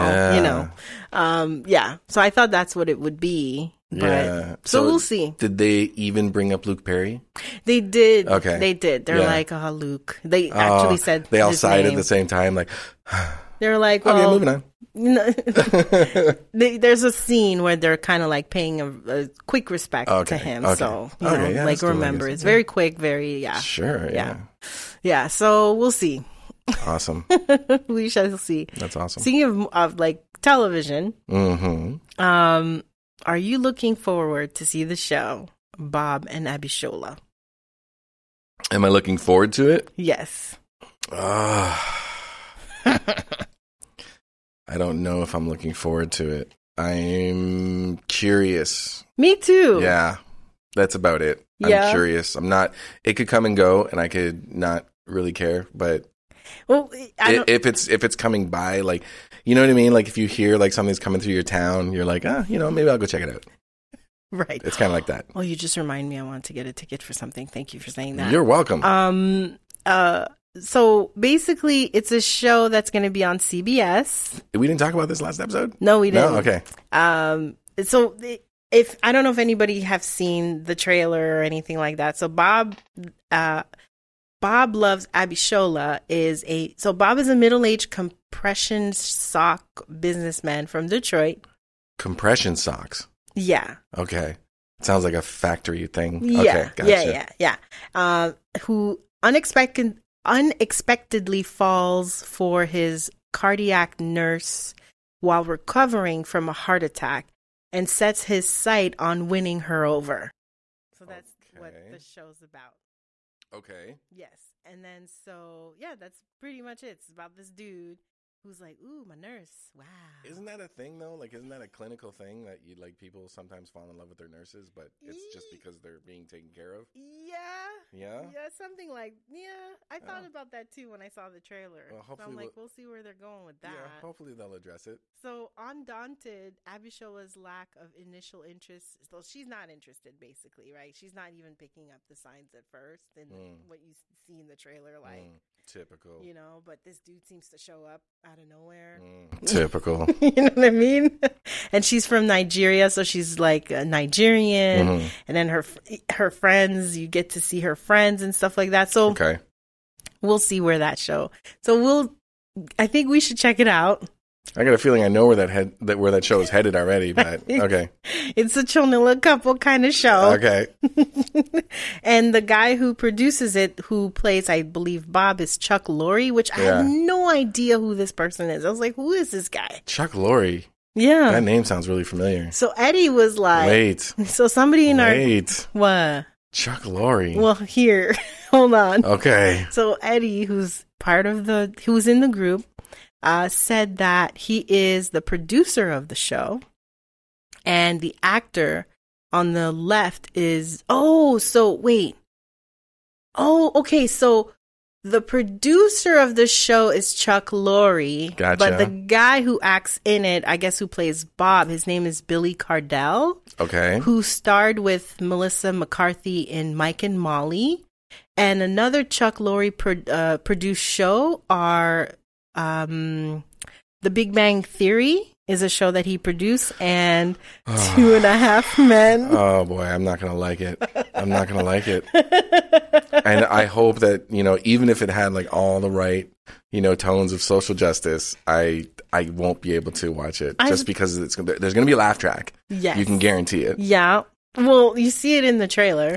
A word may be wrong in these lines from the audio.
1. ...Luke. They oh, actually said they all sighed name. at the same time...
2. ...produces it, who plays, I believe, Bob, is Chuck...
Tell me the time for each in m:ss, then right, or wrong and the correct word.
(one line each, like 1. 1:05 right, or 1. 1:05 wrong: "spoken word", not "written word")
1. 0:09 right
2. 2:52 right.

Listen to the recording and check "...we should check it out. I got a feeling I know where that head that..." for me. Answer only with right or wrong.
right.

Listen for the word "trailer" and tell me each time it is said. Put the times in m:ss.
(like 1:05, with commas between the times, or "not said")
1:20, 2:11, 2:24.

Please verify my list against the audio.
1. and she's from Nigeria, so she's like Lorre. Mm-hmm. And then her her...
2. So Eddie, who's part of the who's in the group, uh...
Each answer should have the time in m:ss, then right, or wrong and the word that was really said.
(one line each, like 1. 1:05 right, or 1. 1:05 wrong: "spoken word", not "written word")
1. 2:31 wrong: "Nigerian", not "Lorre"
2. 3:09 right.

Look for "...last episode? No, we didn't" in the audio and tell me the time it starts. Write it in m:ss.
1:15.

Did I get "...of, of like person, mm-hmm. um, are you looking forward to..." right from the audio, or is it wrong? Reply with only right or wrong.
wrong.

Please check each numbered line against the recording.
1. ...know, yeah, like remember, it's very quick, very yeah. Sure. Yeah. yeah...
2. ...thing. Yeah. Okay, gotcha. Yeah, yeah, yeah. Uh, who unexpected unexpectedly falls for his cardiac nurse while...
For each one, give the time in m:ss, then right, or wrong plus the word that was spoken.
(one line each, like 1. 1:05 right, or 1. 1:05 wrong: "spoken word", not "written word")
1. 0:21 right
2. 1:35 right.